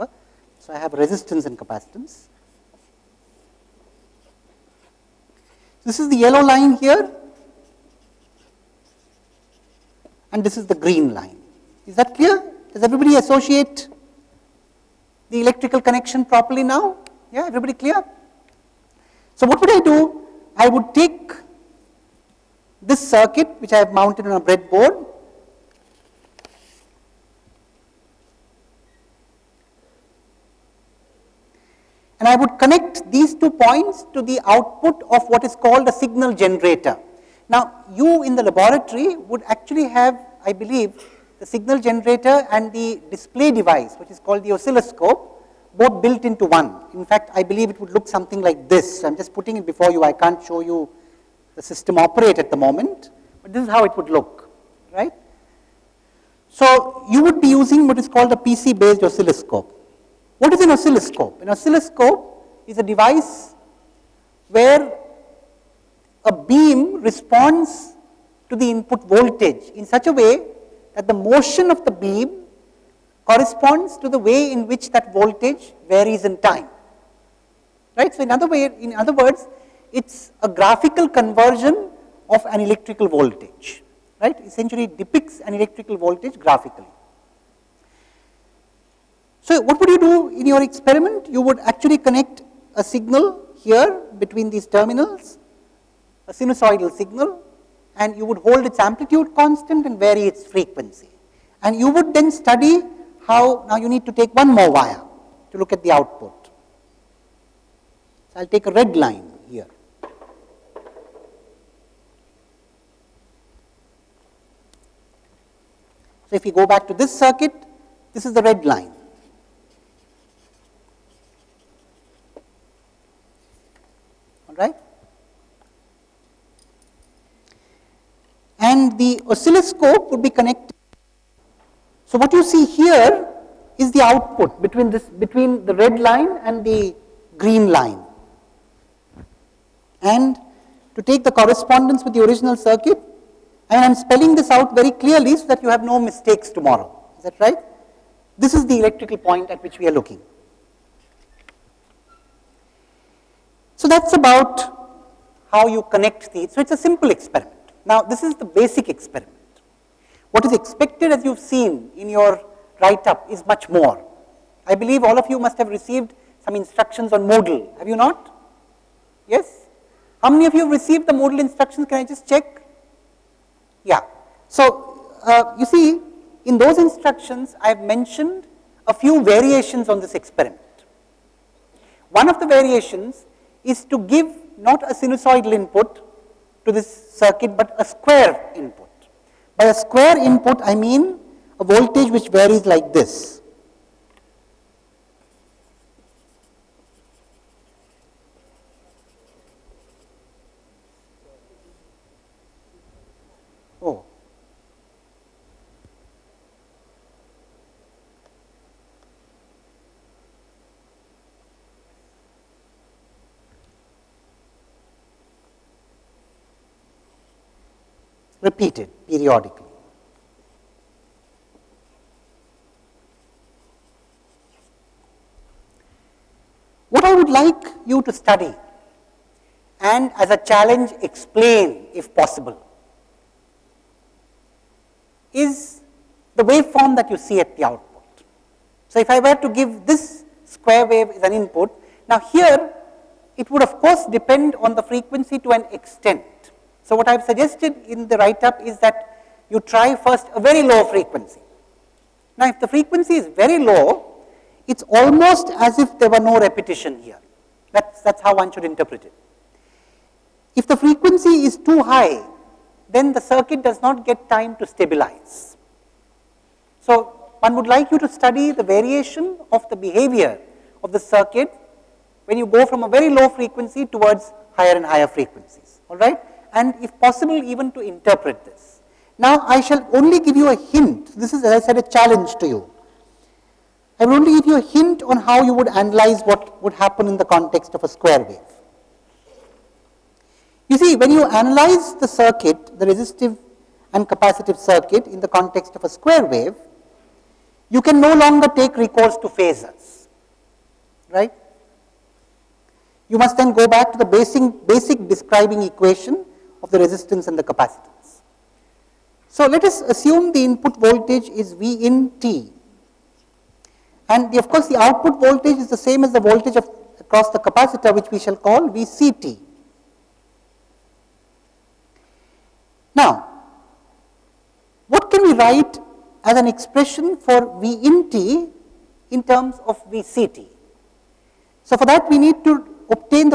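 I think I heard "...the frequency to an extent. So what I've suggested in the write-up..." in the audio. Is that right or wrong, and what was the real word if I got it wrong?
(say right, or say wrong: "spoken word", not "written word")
right.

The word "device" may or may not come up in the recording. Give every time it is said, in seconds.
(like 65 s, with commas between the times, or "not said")
43 s, 62 s.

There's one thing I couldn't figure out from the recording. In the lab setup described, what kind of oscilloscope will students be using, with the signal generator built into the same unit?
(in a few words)
PC-based oscilloscope.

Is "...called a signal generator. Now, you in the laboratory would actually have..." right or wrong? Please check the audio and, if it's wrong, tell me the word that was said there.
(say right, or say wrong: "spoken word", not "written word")
right.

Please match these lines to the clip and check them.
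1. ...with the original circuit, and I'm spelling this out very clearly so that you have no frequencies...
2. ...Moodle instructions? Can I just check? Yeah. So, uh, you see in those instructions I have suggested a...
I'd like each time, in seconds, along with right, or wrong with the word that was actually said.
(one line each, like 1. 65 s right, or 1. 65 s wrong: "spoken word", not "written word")
1. 142 s wrong: "mistakes", not "frequencies"
2. 171 s wrong: "mentioned", not "suggested".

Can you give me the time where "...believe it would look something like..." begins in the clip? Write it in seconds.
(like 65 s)
47 s.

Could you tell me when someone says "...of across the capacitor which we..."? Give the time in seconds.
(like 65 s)
316 s.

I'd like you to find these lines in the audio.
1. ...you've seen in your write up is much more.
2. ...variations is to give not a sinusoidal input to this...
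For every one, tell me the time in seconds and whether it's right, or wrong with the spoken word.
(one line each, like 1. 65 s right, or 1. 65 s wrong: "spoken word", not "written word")
1. 161 s right
2. 182 s right.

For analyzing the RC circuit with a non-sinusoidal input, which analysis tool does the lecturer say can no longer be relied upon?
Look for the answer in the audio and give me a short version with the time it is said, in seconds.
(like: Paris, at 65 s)
Phasors, at 299 s.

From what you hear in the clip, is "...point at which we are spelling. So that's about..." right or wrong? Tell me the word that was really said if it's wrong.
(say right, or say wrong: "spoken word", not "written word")
wrong: "looking", not "spelling".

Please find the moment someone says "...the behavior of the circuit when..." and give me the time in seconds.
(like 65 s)
269 s.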